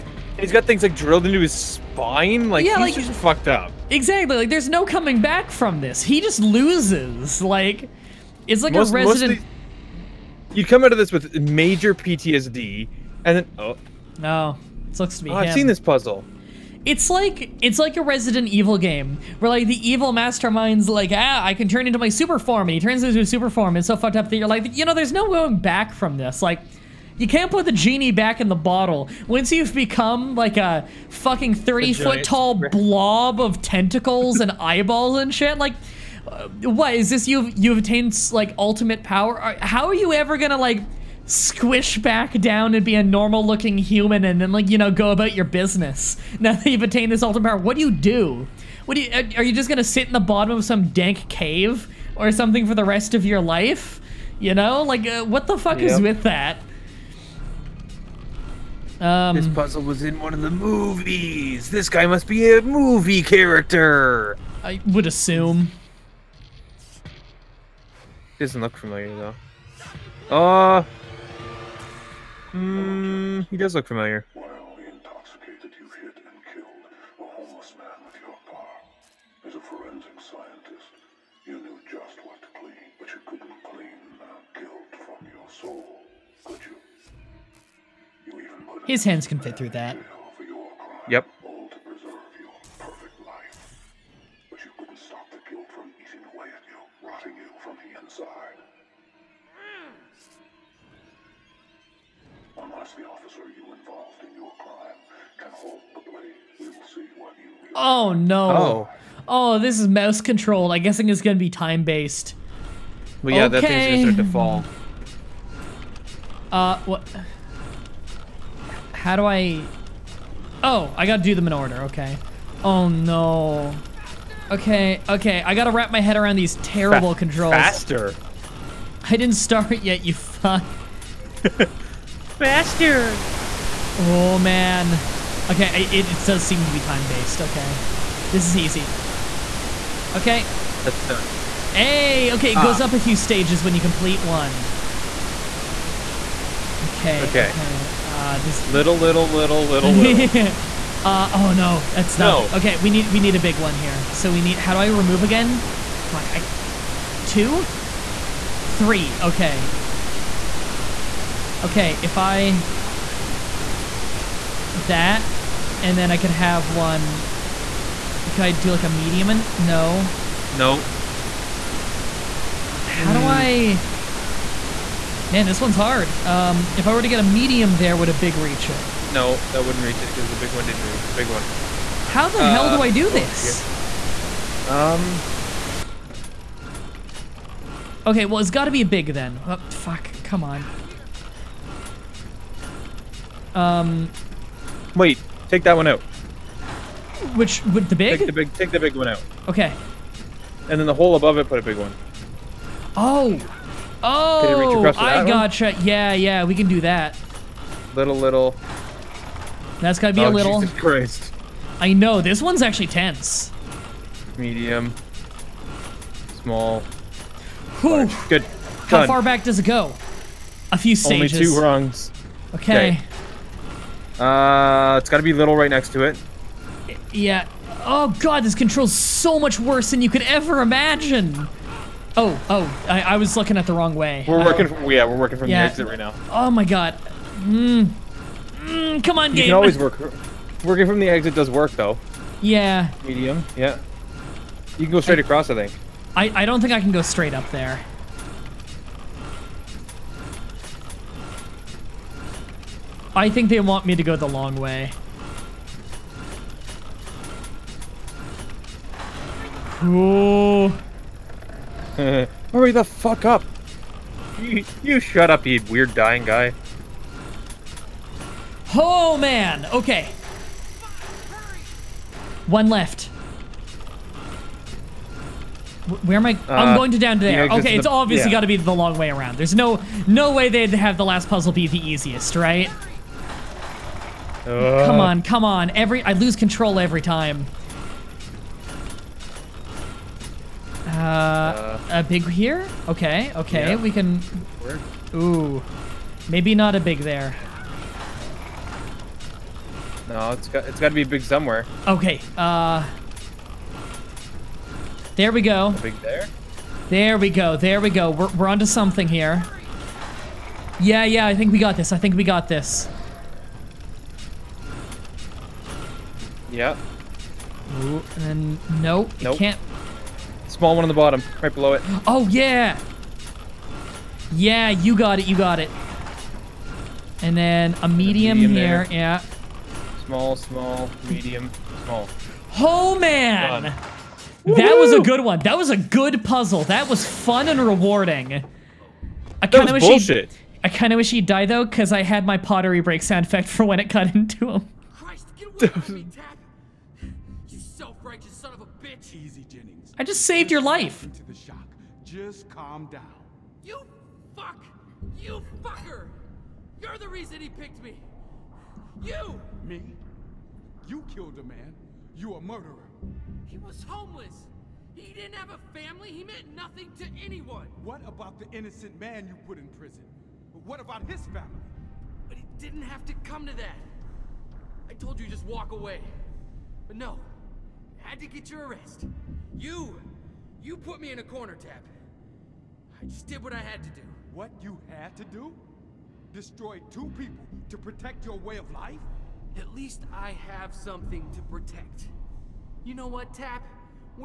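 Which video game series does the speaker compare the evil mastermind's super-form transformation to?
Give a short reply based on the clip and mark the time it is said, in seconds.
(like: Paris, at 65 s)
Resident Evil, at 18 s.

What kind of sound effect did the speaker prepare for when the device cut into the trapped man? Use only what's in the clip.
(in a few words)
pottery break.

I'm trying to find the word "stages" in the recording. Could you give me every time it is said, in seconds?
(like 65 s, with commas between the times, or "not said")
143 s, 220 s.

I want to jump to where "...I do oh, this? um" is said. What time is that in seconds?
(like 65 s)
182 s.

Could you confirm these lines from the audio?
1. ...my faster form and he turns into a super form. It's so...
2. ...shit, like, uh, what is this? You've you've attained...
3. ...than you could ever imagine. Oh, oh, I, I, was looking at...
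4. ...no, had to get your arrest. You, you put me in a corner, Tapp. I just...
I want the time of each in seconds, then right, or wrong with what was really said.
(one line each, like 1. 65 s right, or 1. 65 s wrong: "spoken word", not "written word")
1. 21 s wrong: "super", not "faster"
2. 35 s right
3. 229 s right
4. 376 s right.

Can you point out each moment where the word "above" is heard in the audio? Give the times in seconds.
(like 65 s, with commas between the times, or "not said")
201 s.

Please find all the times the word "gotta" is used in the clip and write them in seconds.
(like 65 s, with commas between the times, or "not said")
121 s, 125 s, 209 s, 225 s.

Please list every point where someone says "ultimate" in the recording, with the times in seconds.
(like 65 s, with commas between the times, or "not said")
38 s, 47 s.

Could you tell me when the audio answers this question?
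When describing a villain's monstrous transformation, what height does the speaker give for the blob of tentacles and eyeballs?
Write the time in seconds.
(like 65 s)
31 s.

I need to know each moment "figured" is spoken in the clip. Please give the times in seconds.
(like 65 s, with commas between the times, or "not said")
not said.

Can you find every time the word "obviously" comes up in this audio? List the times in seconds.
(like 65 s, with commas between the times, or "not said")
277 s.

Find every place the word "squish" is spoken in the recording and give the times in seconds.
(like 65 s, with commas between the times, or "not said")
41 s.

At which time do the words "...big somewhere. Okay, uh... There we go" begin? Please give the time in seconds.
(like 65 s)
301 s.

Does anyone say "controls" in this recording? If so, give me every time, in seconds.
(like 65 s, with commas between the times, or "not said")
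127 s, 228 s, 286 s.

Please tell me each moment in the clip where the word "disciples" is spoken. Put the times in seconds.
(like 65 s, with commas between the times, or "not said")
not said.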